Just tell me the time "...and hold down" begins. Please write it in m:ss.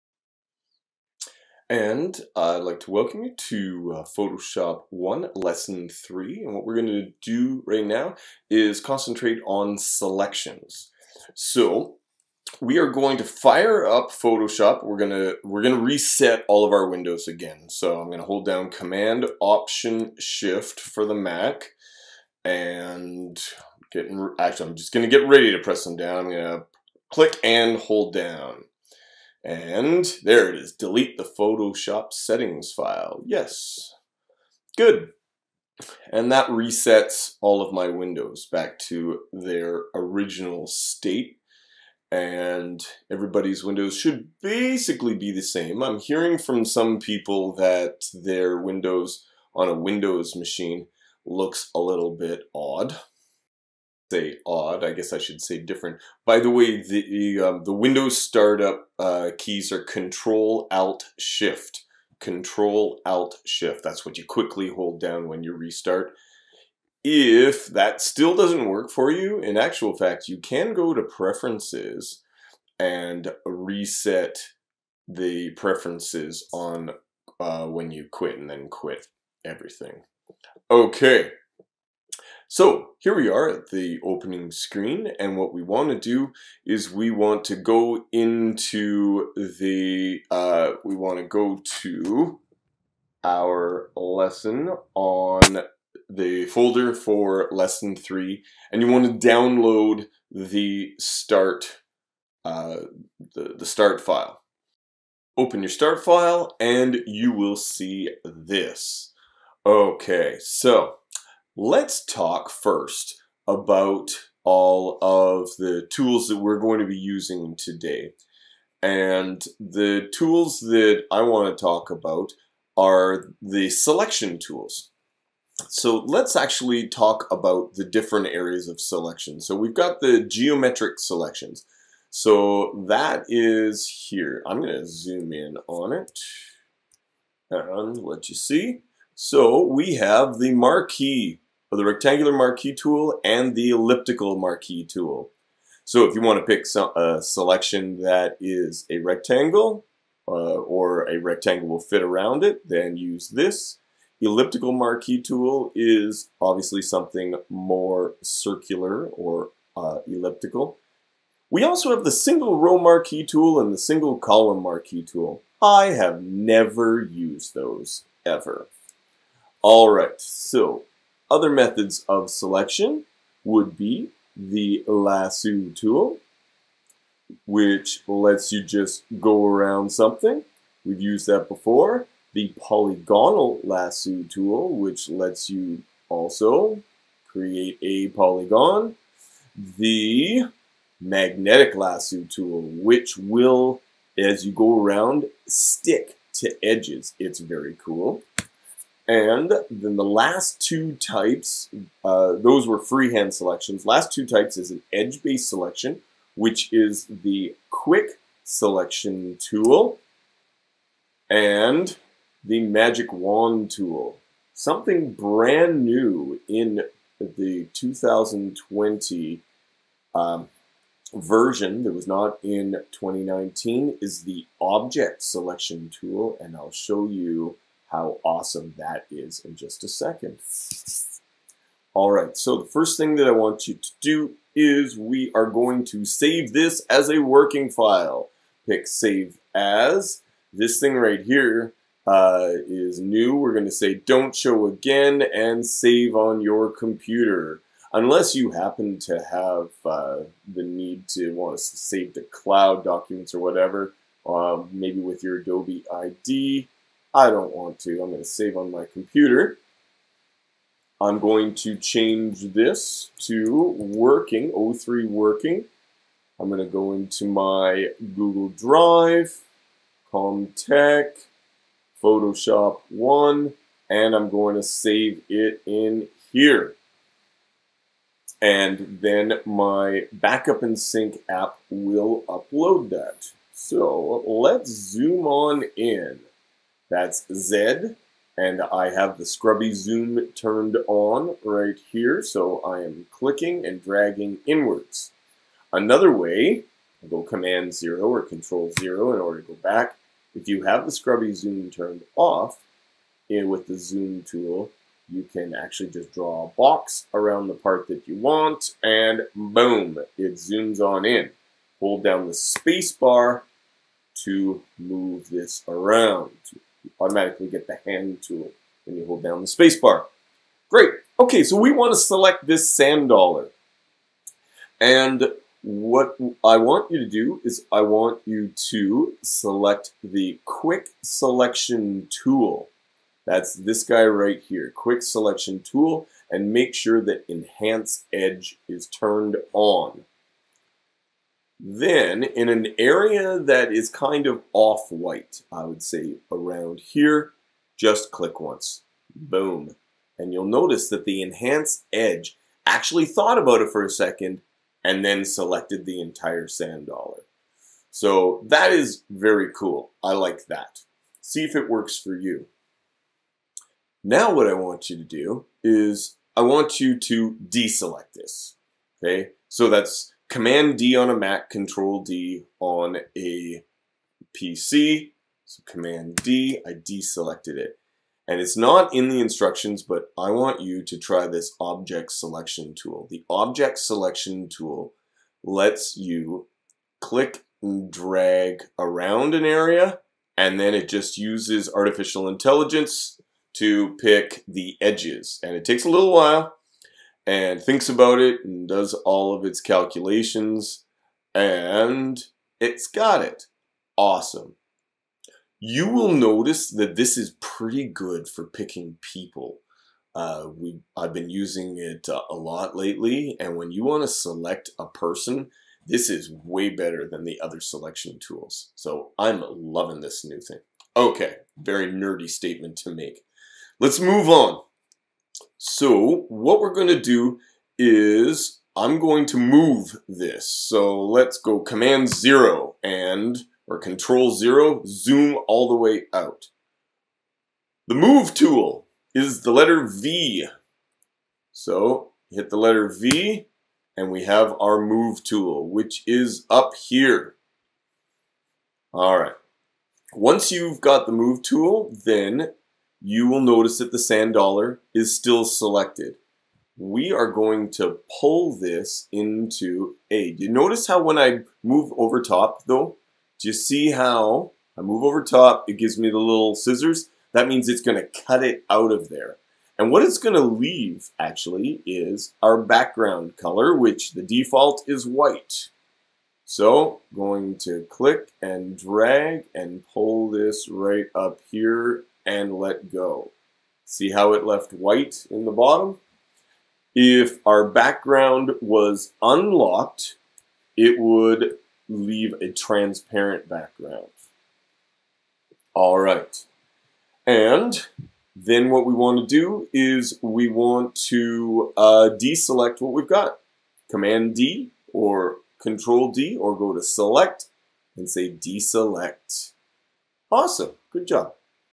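0:27.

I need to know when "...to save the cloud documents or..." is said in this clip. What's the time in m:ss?
4:11.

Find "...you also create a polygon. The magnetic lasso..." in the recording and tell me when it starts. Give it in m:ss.
3:05.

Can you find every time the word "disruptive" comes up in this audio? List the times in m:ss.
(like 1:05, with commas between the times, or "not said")
not said.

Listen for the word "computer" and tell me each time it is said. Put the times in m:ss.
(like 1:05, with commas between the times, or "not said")
4:06, 4:18.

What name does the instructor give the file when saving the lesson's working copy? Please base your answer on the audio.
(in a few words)
O3 working.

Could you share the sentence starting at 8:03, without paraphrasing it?
See how it left white in the bottom?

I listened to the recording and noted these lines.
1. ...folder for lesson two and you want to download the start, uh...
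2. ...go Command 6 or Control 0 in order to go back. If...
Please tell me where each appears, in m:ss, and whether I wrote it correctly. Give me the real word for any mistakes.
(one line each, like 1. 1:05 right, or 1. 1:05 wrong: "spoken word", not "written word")
1. 1:36 wrong: "three", not "two"
2. 4:57 wrong: "0", not "6".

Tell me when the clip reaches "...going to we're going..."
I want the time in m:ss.
0:14.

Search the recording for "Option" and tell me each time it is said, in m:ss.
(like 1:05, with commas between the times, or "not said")
0:19.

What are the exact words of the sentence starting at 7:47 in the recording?
That means it's gonna cut it out of there.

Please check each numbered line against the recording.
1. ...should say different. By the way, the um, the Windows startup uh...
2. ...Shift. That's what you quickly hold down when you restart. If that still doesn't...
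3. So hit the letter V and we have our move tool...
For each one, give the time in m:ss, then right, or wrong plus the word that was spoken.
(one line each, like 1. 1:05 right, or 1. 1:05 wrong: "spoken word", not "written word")
1. 0:55 right
2. 1:03 right
3. 7:21 right.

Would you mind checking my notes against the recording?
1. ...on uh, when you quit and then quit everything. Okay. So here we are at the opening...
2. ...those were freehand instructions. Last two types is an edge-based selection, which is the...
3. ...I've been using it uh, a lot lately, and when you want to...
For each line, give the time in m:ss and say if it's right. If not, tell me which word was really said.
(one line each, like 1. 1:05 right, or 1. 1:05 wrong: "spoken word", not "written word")
1. 1:16 right
2. 3:22 wrong: "selections", not "instructions"
3. 6:50 right.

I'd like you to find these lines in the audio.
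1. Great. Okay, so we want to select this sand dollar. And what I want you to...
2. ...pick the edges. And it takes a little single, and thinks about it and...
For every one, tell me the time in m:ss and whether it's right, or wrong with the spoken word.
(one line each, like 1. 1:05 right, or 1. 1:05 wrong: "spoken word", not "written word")
1. 5:20 right
2. 6:33 wrong: "while", not "single".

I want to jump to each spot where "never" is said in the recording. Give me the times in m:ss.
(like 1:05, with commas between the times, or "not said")
2:46.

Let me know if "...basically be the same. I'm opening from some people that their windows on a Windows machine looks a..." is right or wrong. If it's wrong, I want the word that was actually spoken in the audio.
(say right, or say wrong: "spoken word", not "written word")
wrong: "hearing", not "opening".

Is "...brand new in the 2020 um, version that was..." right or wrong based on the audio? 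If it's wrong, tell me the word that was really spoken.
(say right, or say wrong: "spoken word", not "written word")
right.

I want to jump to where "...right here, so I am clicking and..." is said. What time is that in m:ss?
4:51.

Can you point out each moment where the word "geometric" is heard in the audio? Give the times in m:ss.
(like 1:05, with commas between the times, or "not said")
2:10.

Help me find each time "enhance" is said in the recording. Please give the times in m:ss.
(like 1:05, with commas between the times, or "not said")
5:37, 5:51.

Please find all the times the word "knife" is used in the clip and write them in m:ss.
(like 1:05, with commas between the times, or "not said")
not said.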